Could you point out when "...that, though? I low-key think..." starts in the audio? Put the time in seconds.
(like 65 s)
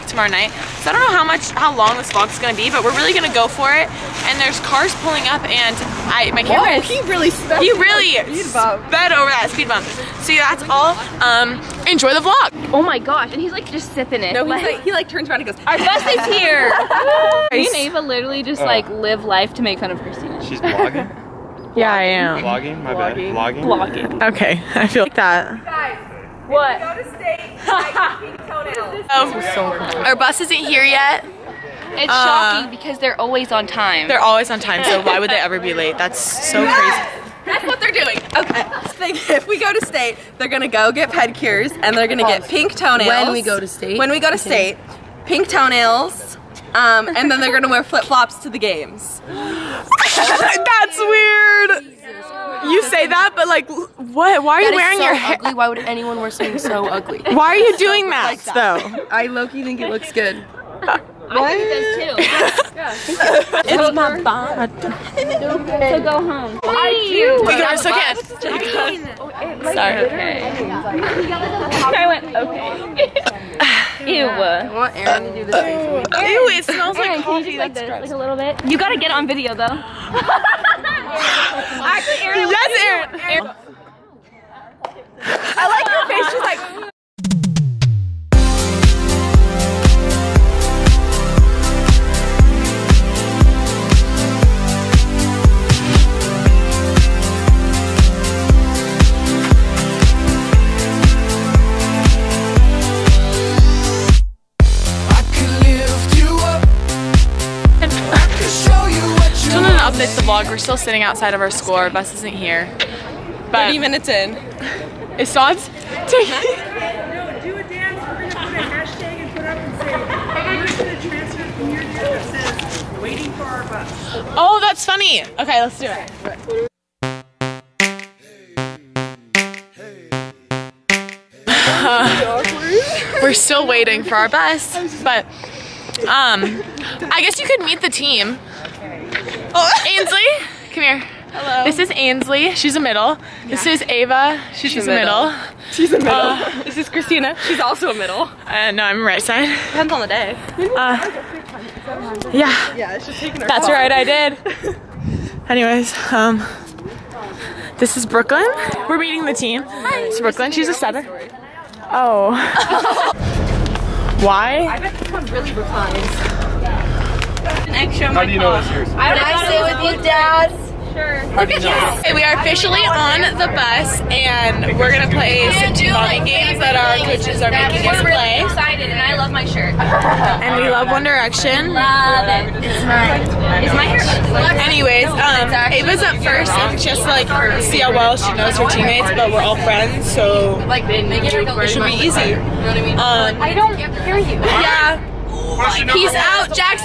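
58 s.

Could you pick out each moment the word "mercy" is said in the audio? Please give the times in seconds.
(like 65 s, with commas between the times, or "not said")
not said.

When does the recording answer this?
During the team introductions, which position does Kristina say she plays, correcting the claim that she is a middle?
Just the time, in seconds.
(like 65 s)
149 s.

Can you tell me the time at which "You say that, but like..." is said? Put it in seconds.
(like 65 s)
52 s.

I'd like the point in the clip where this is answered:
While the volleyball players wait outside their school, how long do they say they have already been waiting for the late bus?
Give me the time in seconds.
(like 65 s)
113 s.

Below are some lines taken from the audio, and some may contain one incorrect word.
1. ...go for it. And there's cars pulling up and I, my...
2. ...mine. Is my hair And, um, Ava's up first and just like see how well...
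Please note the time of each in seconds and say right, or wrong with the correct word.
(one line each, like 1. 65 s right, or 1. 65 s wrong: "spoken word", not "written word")
1. 3 s right
2. 182 s wrong: "Anyways", not "And".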